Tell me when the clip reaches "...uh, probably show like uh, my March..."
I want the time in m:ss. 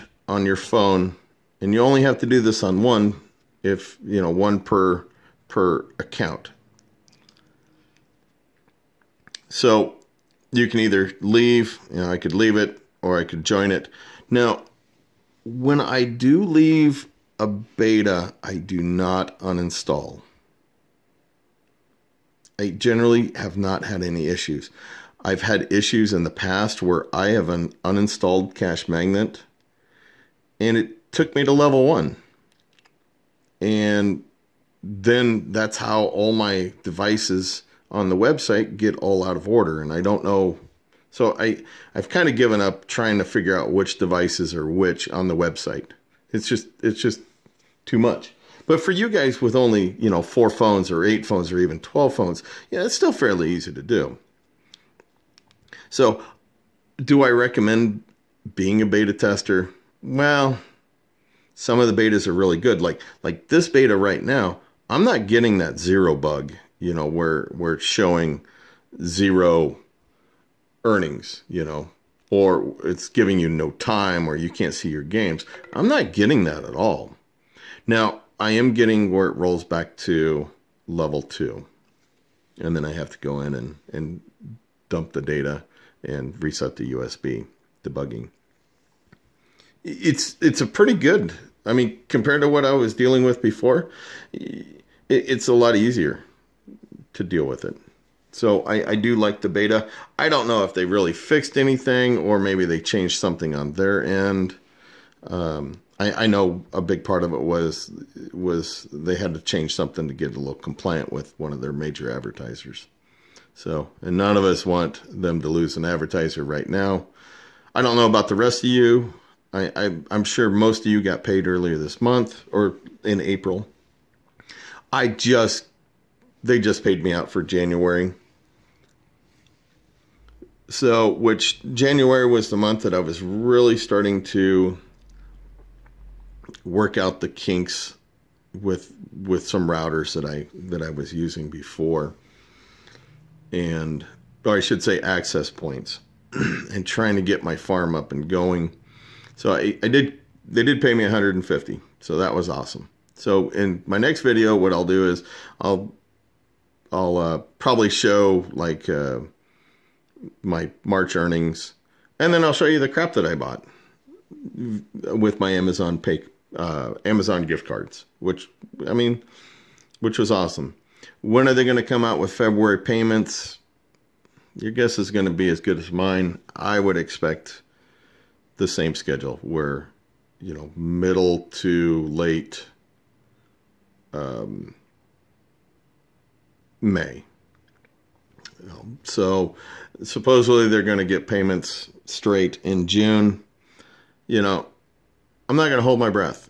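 2:37.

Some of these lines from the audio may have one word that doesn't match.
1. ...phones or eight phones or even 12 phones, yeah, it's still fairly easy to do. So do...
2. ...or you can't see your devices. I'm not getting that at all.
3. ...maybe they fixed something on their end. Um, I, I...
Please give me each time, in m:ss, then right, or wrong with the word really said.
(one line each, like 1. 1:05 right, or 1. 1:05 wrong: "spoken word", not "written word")
1. 0:50 right
2. 1:14 wrong: "games", not "devices"
3. 1:42 wrong: "changed", not "fixed".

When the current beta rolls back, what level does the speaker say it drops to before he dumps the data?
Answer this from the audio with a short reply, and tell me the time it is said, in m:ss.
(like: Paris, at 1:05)
Level 2, at 1:20.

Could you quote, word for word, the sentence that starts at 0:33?
And then that's how all my devices on the website get all out of order.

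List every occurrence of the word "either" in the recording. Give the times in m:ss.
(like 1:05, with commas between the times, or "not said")
0:10.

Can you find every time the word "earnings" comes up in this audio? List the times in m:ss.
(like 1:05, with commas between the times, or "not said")
1:10, 2:41.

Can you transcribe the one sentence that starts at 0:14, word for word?
Now, when I do leave a beta, I do not uninstall.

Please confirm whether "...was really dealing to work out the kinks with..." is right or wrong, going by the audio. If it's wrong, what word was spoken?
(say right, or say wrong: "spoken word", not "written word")
wrong: "starting", not "dealing".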